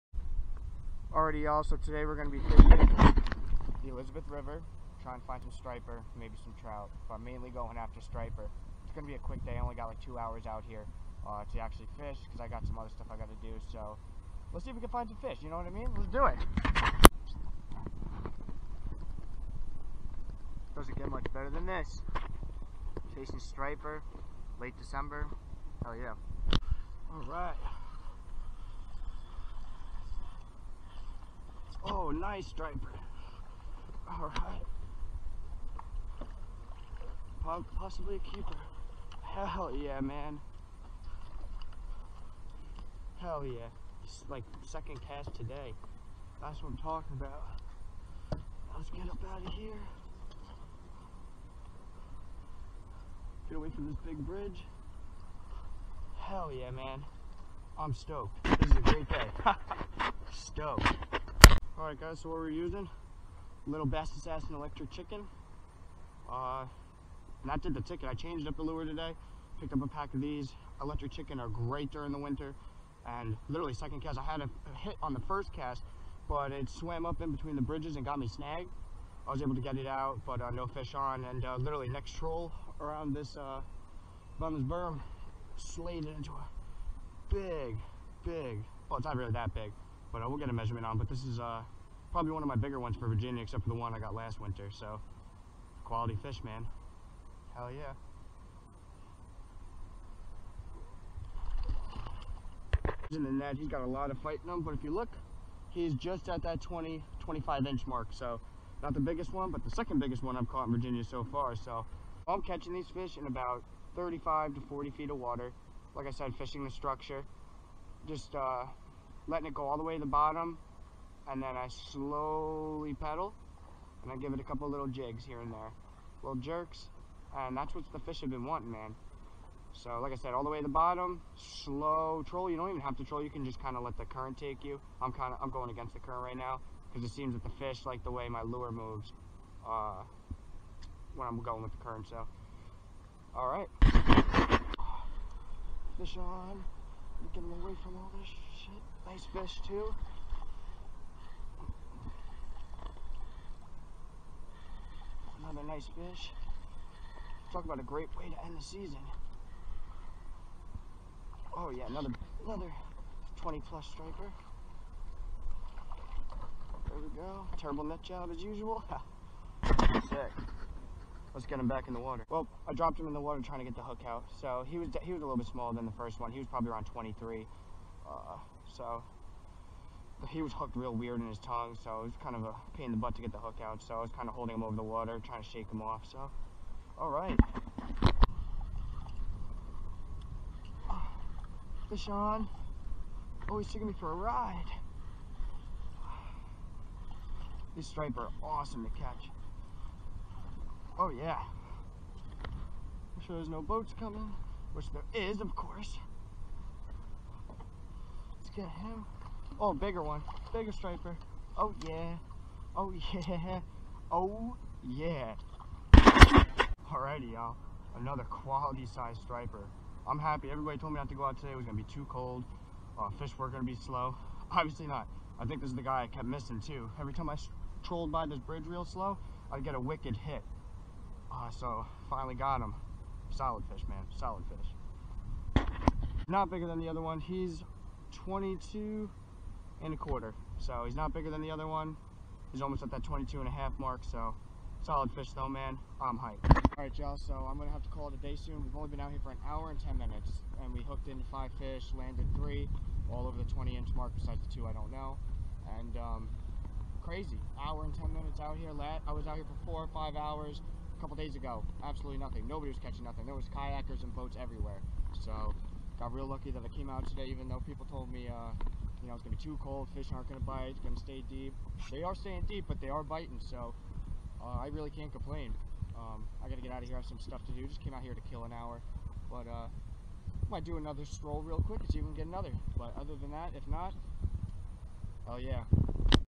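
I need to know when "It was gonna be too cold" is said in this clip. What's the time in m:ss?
3:41.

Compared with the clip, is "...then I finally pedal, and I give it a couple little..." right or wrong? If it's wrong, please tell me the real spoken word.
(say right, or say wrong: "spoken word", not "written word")
wrong: "slowly", not "finally".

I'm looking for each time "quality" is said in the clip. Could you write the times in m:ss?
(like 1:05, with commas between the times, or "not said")
1:35, 3:38.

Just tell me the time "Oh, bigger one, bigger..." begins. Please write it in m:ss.
3:29.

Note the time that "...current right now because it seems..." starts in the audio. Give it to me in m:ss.
2:16.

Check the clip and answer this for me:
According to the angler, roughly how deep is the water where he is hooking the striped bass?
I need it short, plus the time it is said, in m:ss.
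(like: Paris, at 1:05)
35 to 40 feet, at 1:53.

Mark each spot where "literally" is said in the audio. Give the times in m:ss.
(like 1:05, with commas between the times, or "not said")
1:13, 1:21.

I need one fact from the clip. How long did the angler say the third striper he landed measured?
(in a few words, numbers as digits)
22 and a quarter inches.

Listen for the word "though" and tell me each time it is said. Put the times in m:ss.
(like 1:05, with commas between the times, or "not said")
4:05, 4:27.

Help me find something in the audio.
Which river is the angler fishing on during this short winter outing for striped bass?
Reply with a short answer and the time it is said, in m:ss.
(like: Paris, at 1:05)
Elizabeth River, at 0:03.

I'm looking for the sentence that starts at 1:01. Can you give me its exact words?
All right guys, so what we're using, little Bass Assassin Electric Chicken.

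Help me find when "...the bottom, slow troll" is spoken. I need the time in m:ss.
2:10.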